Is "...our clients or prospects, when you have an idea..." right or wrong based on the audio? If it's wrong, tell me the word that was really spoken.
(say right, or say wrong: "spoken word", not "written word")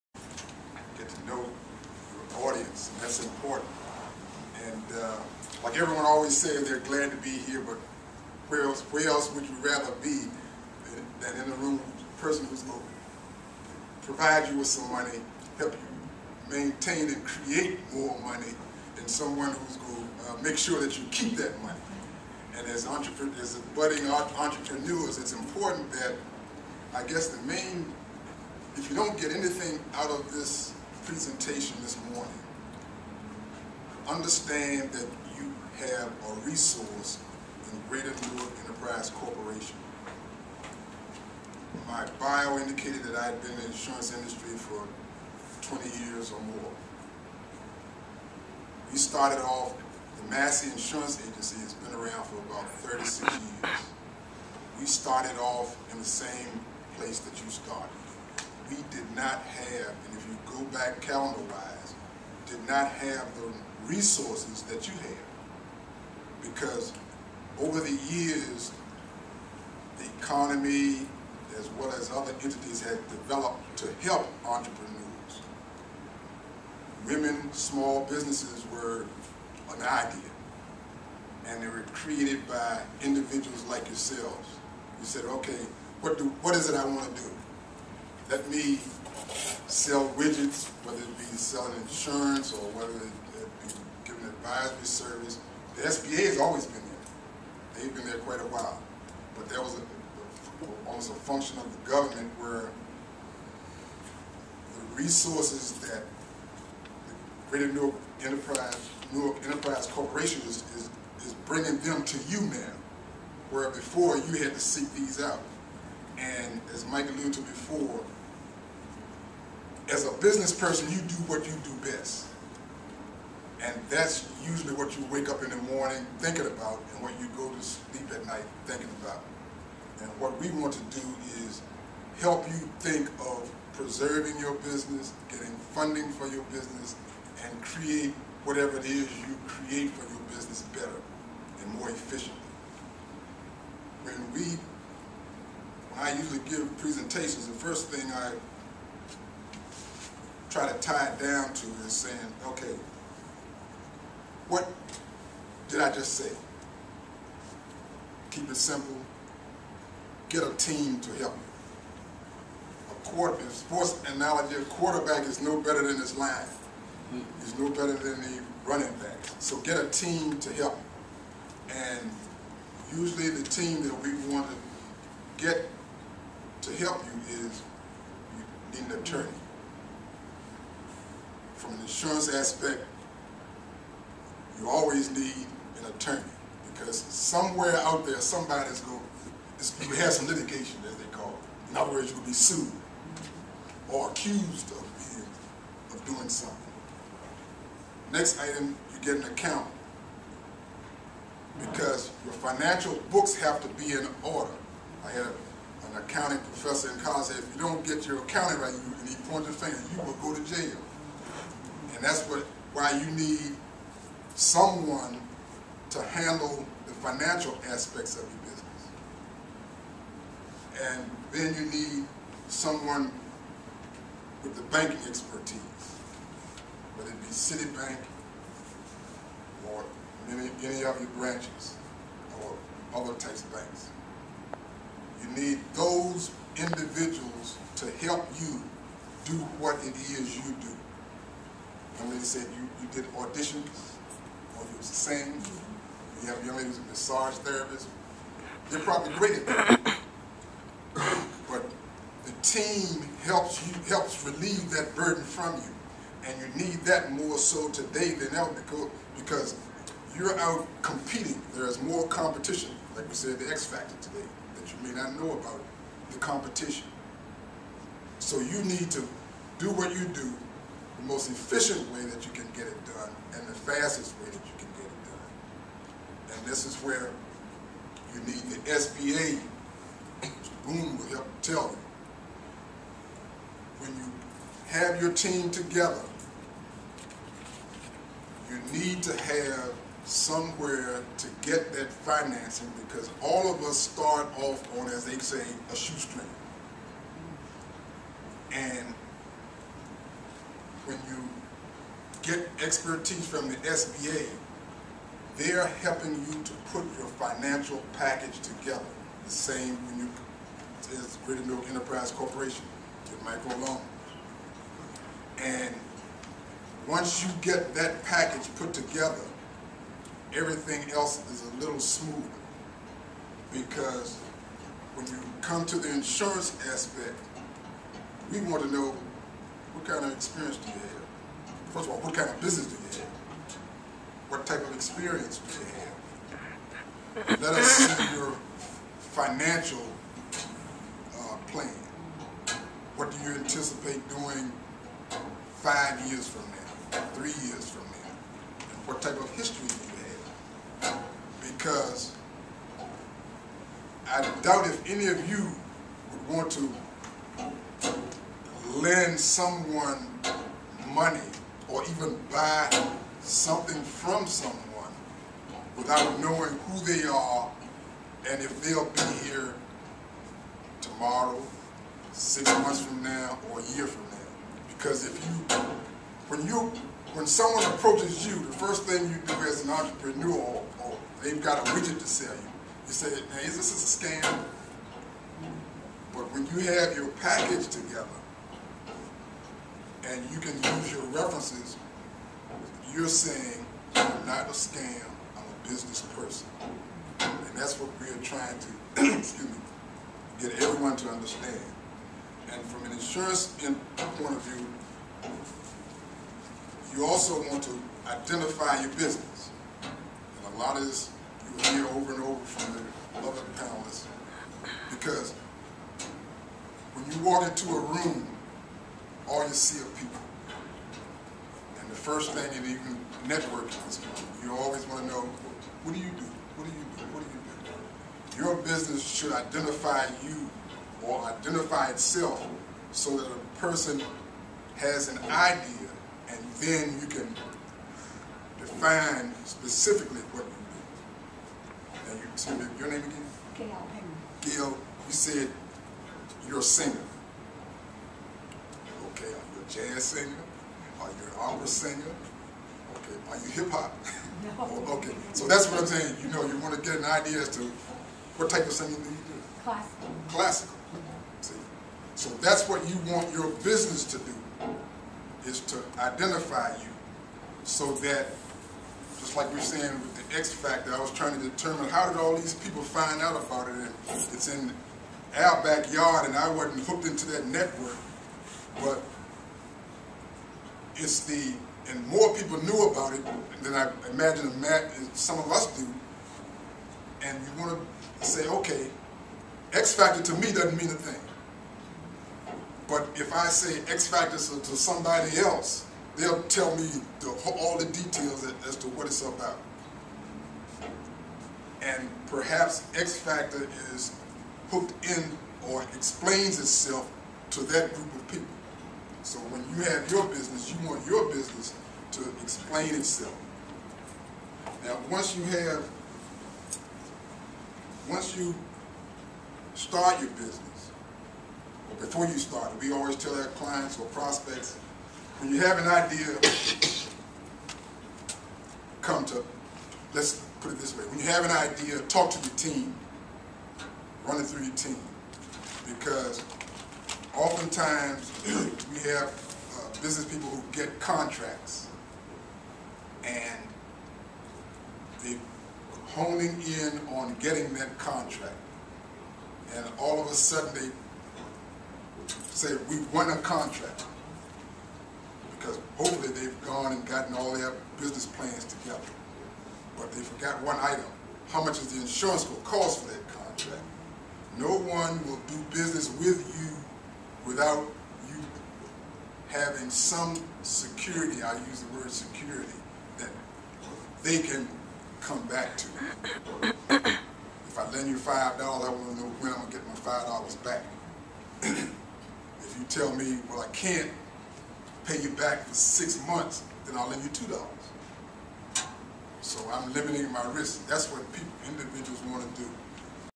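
right.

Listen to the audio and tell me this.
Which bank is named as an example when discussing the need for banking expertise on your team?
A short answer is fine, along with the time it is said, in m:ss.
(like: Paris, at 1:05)
Citibank, at 3:47.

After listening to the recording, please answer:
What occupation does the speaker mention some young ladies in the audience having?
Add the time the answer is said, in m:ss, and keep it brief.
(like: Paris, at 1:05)
massage therapist, at 4:06.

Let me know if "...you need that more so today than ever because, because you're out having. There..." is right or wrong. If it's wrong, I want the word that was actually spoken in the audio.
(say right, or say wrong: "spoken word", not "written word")
wrong: "competing", not "having".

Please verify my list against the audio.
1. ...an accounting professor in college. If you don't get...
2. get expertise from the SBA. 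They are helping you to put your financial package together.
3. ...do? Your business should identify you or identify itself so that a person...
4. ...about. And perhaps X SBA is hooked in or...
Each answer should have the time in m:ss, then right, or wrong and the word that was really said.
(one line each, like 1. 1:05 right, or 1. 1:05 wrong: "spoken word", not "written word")
1. 3:25 right
2. 5:02 right
3. 7:07 right
4. 8:19 wrong: "Factor", not "SBA".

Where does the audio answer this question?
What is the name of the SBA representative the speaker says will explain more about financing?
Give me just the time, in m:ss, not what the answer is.
4:40.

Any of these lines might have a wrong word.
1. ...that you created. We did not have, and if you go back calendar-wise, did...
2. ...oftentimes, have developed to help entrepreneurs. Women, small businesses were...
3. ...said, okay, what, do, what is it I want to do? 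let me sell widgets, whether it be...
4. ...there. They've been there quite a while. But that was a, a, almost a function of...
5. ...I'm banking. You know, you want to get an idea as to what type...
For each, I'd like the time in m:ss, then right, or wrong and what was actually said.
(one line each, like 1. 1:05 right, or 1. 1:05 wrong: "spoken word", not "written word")
1. 0:57 wrong: "started", not "created"
2. 1:12 wrong: "entities", not "oftentimes"
3. 1:25 right
4. 1:36 right
5. 7:35 wrong: "saying", not "banking".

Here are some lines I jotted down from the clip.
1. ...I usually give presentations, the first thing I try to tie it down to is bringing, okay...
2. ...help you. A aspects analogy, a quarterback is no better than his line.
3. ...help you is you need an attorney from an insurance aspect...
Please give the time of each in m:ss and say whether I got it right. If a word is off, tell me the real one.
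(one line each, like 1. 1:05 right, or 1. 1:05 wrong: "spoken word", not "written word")
1. 2:25 wrong: "saying", not "bringing"
2. 2:41 wrong: "sports", not "aspects"
3. 2:56 right.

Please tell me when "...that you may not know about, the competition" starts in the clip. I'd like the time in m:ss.
4:24.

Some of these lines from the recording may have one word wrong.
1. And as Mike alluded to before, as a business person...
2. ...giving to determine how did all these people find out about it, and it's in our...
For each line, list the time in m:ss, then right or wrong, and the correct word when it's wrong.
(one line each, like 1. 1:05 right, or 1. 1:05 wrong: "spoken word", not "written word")
1. 1:56 right
2. 7:51 wrong: "trying", not "giving".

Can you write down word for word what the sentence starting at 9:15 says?
Because hopefully they've gone and gotten all their business plans together.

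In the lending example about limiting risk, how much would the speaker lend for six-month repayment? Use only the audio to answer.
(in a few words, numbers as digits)
$2.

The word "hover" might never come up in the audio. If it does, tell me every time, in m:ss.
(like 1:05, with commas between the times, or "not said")
not said.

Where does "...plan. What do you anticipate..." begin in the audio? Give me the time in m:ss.
5:41.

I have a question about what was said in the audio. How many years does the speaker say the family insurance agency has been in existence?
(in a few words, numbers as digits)
36.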